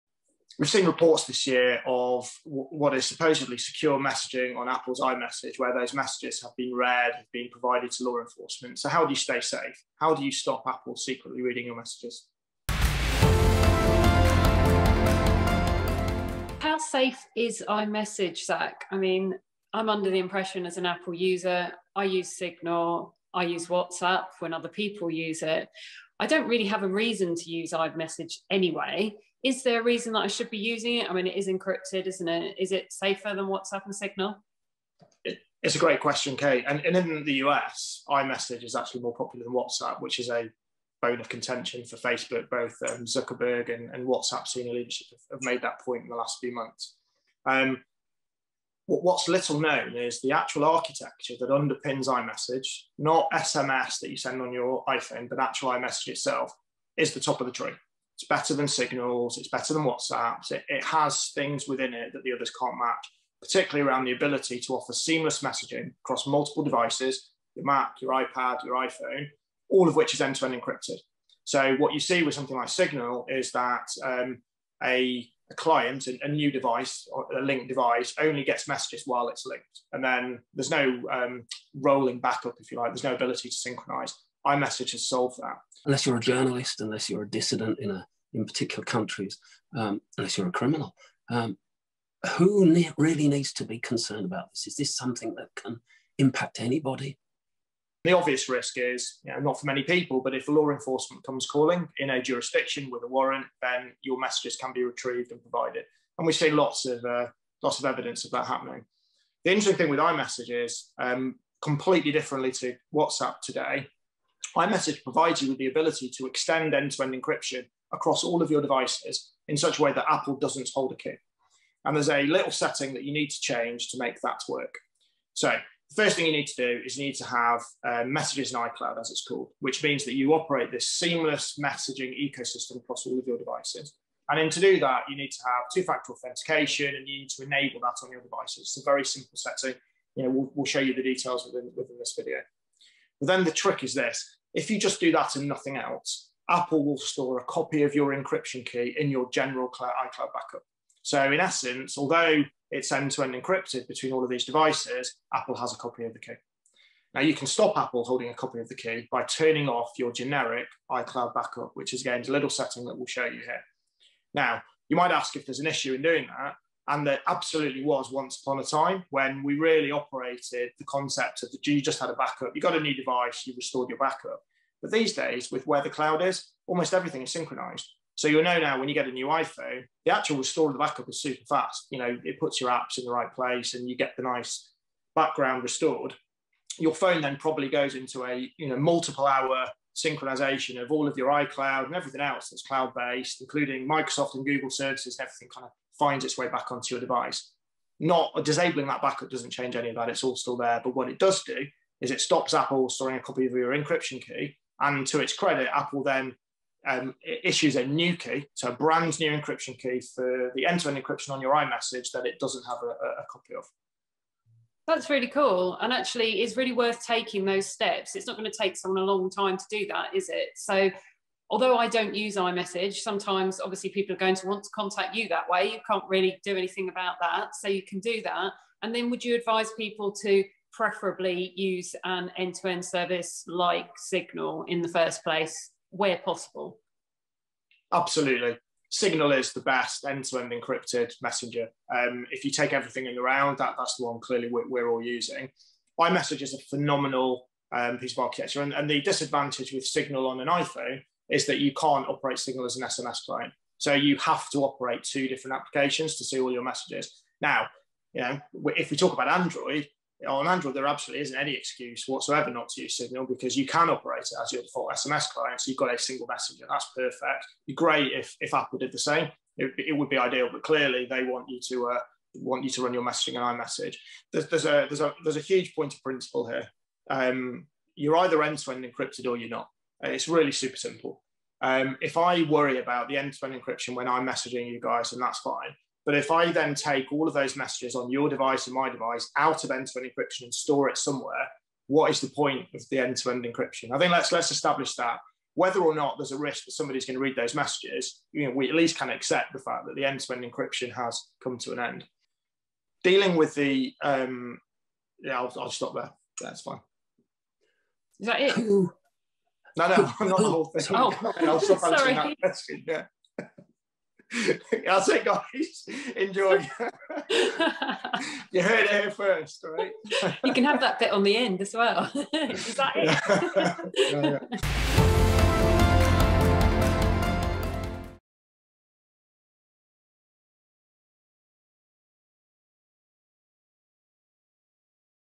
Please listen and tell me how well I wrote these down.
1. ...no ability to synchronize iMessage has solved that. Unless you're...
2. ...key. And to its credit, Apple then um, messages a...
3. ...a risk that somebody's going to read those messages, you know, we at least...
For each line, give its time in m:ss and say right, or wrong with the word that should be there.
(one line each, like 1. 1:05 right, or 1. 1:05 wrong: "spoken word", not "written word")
1. 1:23 right
2. 3:24 wrong: "issues", not "messages"
3. 4:56 right.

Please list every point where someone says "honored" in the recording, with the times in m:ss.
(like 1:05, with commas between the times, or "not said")
not said.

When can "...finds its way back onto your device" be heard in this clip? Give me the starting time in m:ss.
3:16.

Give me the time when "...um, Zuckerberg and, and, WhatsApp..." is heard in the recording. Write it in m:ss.
0:42.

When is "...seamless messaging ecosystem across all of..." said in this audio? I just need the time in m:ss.
2:10.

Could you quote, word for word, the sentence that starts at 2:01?
And there's a little setting that you need to change to make that work.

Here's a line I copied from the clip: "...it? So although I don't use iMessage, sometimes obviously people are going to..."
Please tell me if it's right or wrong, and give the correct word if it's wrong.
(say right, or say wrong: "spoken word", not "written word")
right.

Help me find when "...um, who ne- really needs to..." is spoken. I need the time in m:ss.
1:31.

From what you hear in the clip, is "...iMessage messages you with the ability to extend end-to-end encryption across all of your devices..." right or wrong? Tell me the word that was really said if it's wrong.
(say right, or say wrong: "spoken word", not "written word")
wrong: "provides", not "messages".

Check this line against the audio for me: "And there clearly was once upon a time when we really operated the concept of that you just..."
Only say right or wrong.
wrong.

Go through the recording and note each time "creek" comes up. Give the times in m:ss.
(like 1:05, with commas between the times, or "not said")
not said.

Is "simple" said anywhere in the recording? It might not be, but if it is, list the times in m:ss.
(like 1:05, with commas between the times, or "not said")
2:19, 4:40.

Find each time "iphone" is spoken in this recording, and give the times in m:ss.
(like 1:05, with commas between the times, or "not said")
0:54, 1:08, 2:59, 4:10.